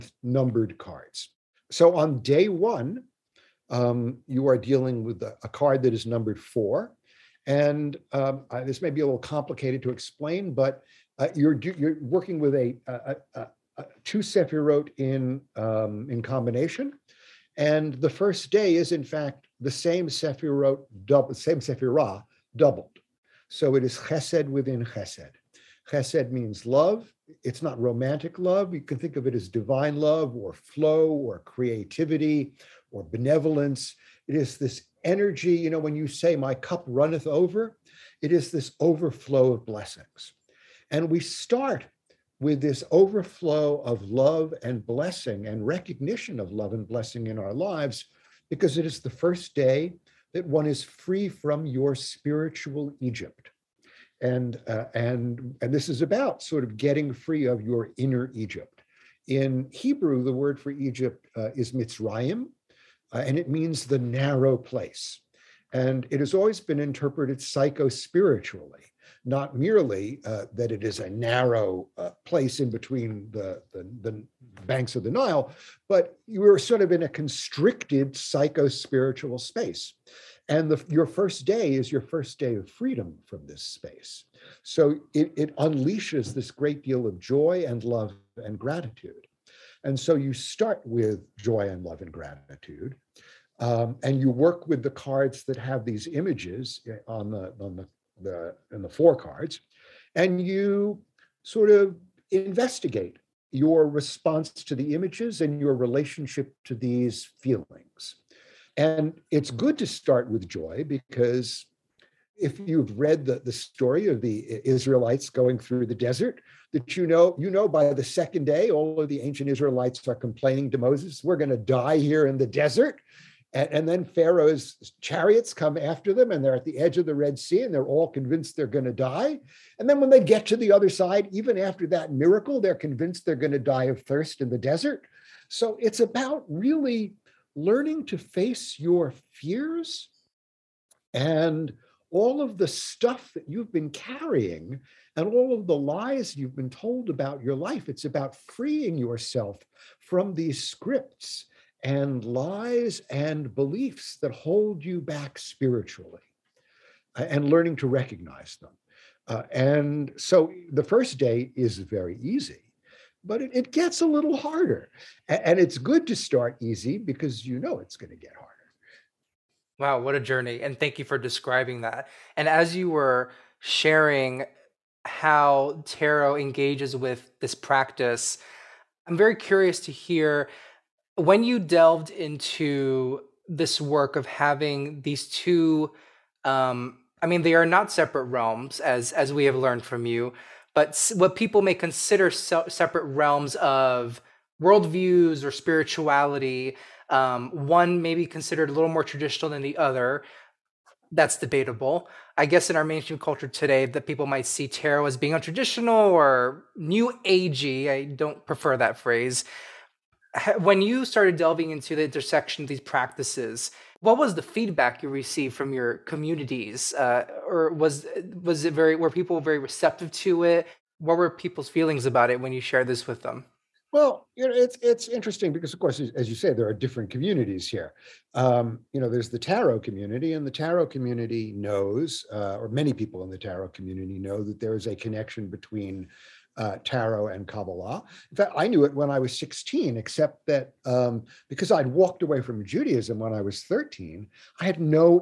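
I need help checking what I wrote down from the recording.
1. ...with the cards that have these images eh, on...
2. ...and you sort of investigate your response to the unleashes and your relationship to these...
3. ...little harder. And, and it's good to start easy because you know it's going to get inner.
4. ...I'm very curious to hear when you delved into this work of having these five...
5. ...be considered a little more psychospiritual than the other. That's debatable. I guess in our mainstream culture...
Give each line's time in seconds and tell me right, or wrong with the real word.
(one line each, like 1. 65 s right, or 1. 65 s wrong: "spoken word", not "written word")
1. 94 s right
2. 100 s wrong: "images", not "unleashes"
3. 164 s wrong: "harder", not "inner"
4. 179 s wrong: "two", not "five"
5. 198 s wrong: "traditional", not "psychospiritual".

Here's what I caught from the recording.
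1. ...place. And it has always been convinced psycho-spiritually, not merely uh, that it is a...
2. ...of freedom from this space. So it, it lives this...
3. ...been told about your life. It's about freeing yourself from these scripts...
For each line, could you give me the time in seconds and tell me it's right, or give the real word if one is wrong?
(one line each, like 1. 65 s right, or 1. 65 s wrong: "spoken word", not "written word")
1. 64 s wrong: "interpreted", not "convinced"
2. 82 s wrong: "unleashes", not "lives"
3. 146 s right.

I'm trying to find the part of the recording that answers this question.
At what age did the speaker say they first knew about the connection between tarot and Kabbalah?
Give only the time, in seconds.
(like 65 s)
239 s.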